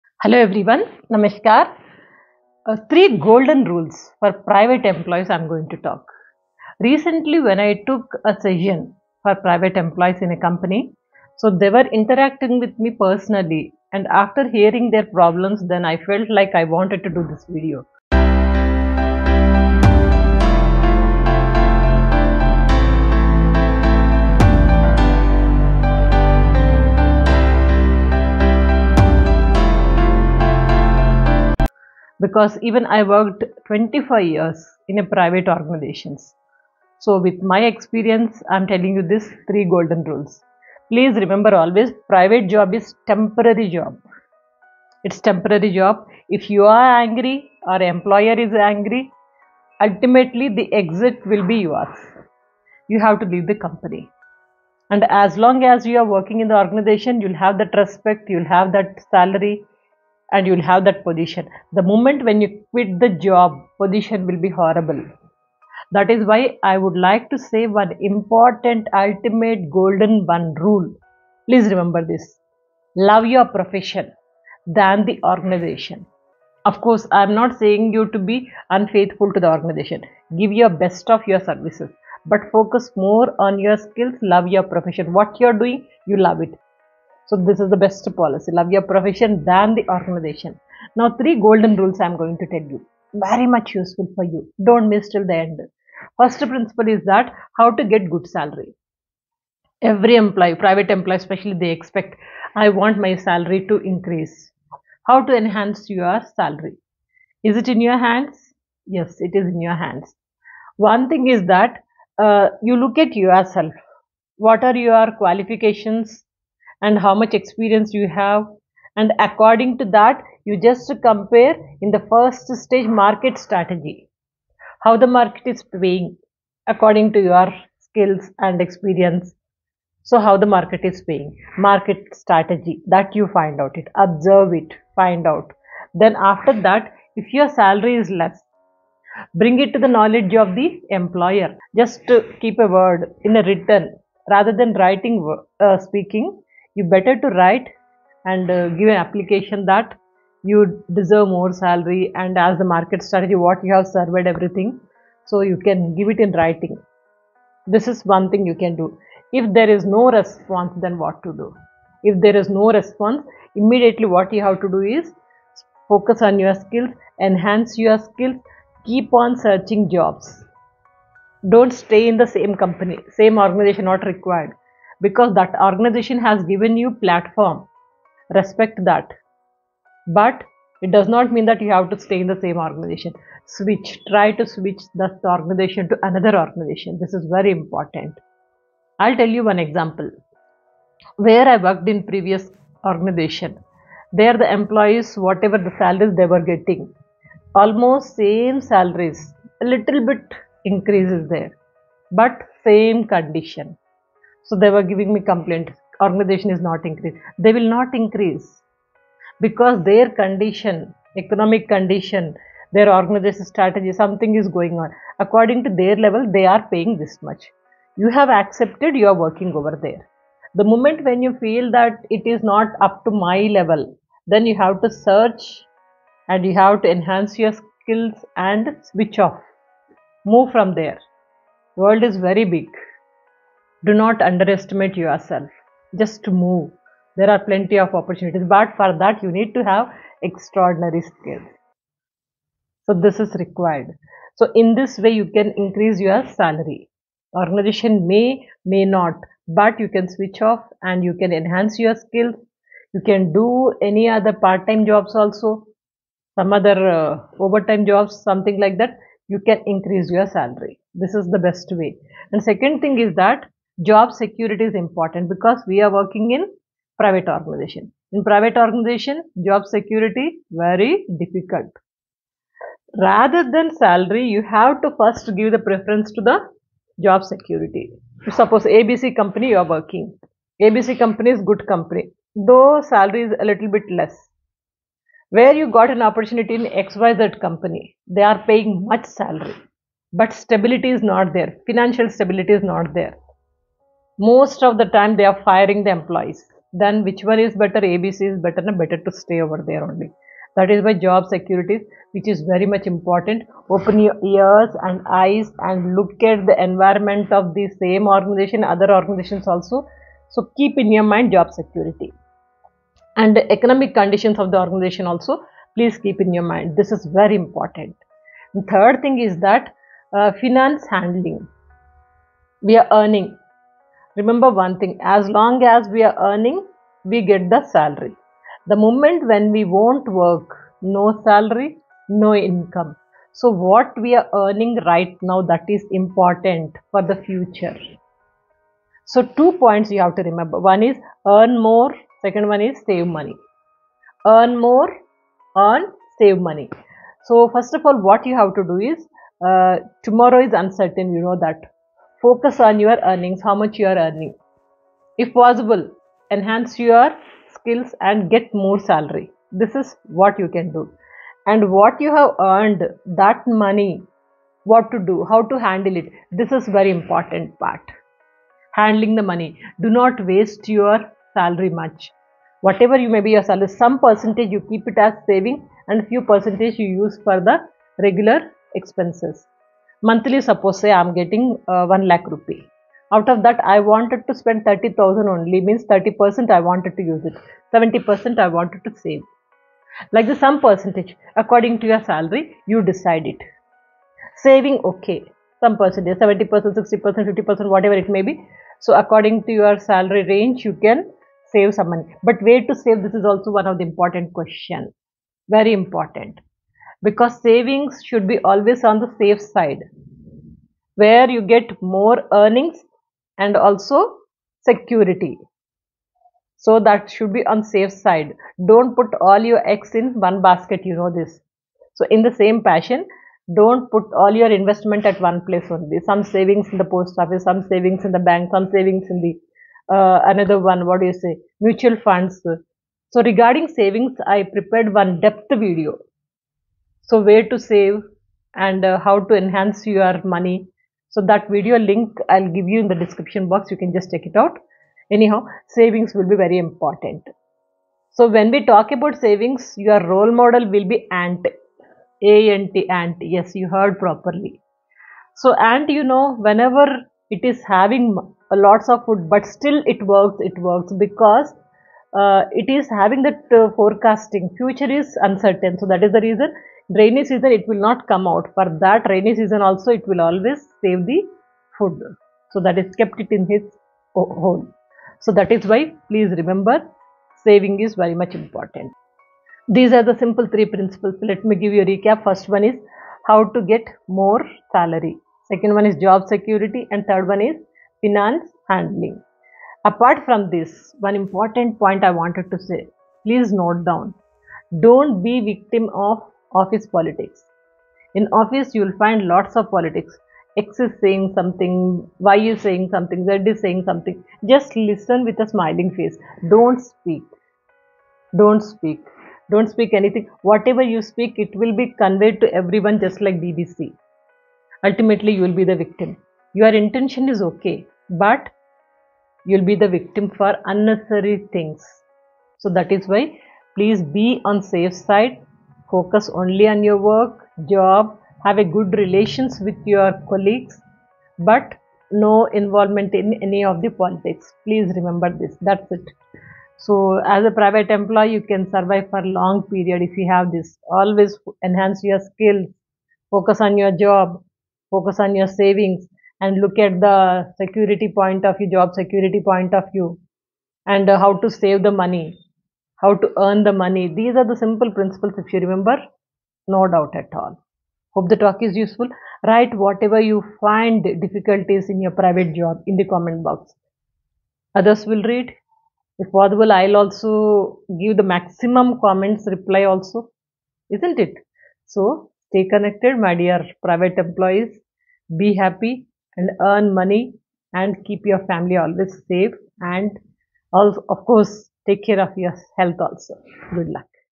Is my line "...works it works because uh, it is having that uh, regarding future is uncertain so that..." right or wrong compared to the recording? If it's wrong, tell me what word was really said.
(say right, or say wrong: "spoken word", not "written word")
wrong: "forecasting", not "regarding".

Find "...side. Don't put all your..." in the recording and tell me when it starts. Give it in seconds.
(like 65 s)
417 s.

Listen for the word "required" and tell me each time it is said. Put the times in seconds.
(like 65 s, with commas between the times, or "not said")
174 s, 243 s.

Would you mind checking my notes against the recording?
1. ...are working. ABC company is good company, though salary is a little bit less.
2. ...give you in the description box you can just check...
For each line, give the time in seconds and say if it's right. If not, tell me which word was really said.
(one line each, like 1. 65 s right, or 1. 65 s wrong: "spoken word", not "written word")
1. 279 s right
2. 442 s right.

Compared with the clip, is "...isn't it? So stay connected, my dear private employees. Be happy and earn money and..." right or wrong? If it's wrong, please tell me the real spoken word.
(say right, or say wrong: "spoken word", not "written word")
right.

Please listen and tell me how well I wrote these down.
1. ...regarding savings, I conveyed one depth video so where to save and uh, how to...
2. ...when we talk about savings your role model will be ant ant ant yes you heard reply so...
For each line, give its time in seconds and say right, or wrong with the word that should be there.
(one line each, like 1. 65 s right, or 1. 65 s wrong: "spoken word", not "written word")
1. 433 s wrong: "prepared", not "conveyed"
2. 448 s wrong: "properly", not "reply".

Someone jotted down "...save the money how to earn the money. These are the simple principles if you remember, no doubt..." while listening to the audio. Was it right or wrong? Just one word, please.
right.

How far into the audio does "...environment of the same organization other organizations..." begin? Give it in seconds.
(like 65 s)
306 s.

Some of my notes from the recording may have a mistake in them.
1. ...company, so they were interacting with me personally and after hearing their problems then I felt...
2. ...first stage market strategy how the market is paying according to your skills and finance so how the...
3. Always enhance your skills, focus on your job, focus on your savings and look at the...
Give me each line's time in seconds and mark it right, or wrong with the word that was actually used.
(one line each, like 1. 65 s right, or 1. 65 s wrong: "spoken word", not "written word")
1. 10 s right
2. 122 s wrong: "experience", not "finance"
3. 540 s right.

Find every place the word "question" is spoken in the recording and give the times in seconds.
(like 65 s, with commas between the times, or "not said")
404 s.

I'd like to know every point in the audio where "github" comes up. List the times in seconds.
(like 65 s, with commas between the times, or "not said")
not said.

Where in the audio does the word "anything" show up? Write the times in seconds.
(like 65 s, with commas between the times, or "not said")
509 s.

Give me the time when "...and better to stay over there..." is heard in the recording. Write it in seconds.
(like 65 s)
298 s.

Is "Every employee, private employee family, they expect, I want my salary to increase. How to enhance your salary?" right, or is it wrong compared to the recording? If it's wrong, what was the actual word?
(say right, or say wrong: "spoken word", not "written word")
wrong: "especially", not "family".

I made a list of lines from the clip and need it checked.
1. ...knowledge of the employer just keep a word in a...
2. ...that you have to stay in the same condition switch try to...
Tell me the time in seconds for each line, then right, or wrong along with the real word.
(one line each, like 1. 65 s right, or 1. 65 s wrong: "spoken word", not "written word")
1. 139 s right
2. 181 s wrong: "organization", not "condition".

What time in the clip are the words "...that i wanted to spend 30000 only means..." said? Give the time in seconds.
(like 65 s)
383 s.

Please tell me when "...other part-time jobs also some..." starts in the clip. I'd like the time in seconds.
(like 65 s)
254 s.